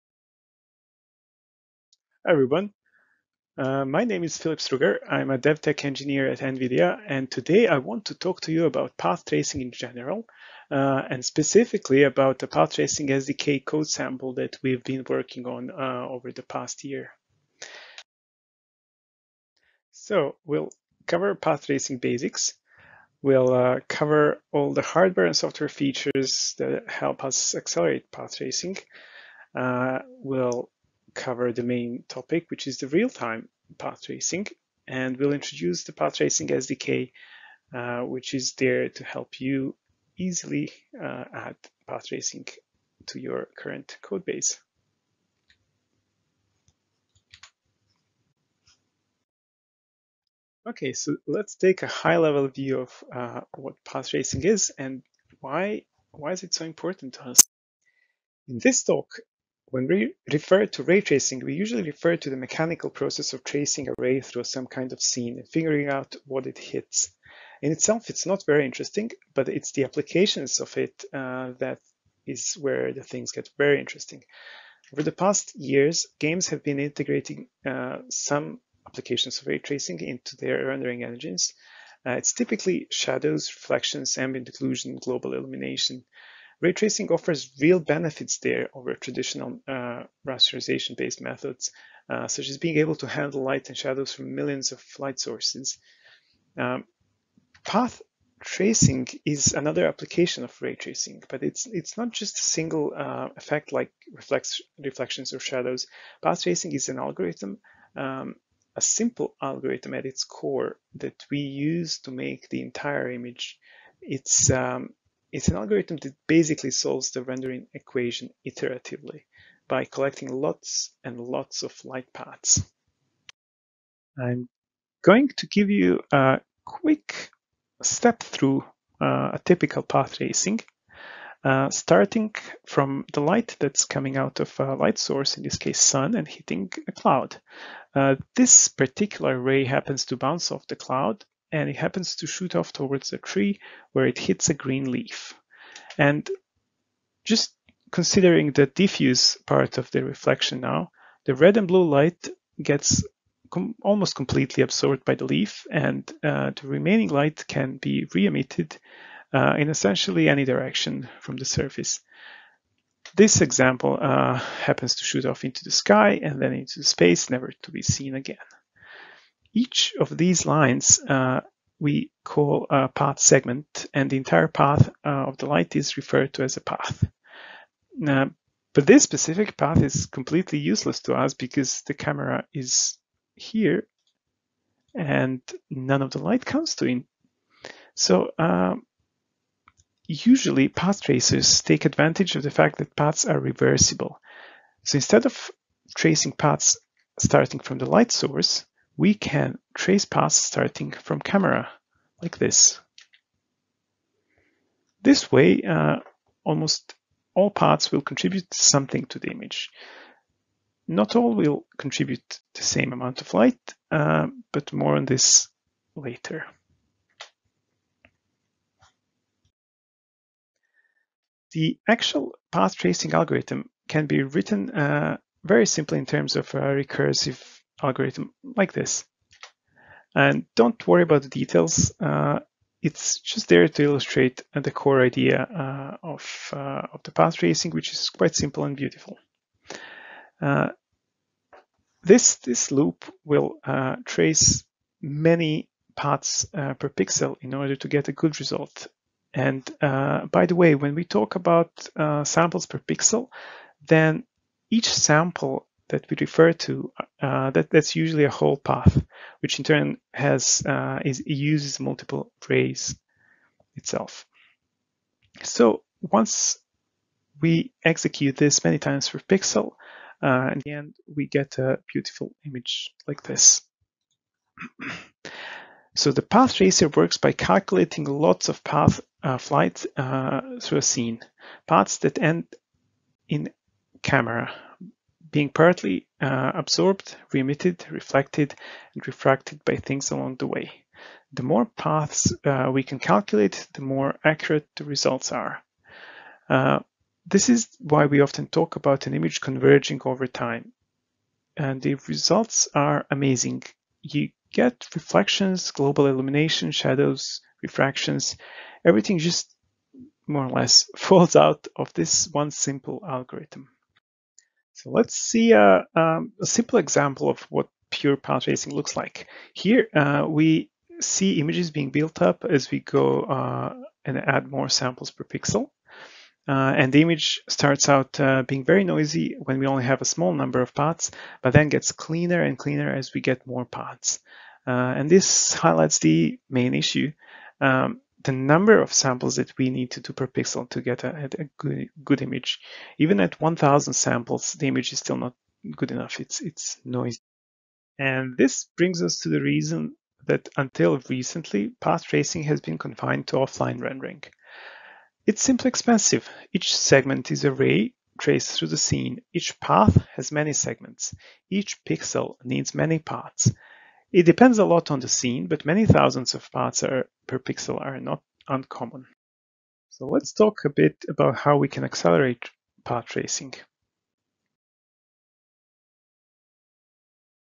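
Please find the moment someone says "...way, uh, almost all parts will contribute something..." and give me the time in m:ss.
3:25.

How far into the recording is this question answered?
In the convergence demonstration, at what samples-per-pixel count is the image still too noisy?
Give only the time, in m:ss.
5:43.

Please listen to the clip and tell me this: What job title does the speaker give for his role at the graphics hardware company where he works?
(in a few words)
DevTech engineer.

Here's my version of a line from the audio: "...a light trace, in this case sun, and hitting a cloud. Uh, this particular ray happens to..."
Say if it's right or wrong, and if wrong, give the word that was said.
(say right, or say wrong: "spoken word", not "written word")
wrong: "source", not "trace".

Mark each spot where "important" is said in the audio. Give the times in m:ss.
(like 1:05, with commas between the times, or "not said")
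0:56.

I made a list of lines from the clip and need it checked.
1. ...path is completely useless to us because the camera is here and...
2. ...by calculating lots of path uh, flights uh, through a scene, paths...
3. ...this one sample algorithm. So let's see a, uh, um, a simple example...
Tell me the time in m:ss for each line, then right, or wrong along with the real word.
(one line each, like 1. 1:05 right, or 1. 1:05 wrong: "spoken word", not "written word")
1. 2:59 right
2. 4:37 right
3. 5:11 wrong: "simple", not "sample".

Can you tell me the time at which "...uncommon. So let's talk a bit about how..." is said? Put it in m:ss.
6:08.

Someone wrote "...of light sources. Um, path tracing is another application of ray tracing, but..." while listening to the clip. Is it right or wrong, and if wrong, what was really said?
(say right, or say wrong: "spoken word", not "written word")
right.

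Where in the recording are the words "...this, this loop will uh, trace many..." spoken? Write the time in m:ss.
4:02.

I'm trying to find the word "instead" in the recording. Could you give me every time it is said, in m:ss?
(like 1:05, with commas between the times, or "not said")
3:14.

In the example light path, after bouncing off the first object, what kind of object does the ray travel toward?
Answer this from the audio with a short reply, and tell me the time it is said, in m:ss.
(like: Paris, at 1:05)
a tree, at 2:23.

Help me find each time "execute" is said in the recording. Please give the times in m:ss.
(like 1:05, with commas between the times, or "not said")
4:27.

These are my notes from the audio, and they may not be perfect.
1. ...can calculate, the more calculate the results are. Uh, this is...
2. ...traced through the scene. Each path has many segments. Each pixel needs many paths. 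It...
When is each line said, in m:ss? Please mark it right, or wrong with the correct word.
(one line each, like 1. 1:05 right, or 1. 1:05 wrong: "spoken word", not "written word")
1. 4:52 wrong: "accurate", not "calculate"
2. 5:58 right.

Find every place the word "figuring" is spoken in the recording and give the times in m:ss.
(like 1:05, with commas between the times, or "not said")
1:05.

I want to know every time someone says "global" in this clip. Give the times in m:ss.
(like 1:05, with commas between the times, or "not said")
1:24, 5:05.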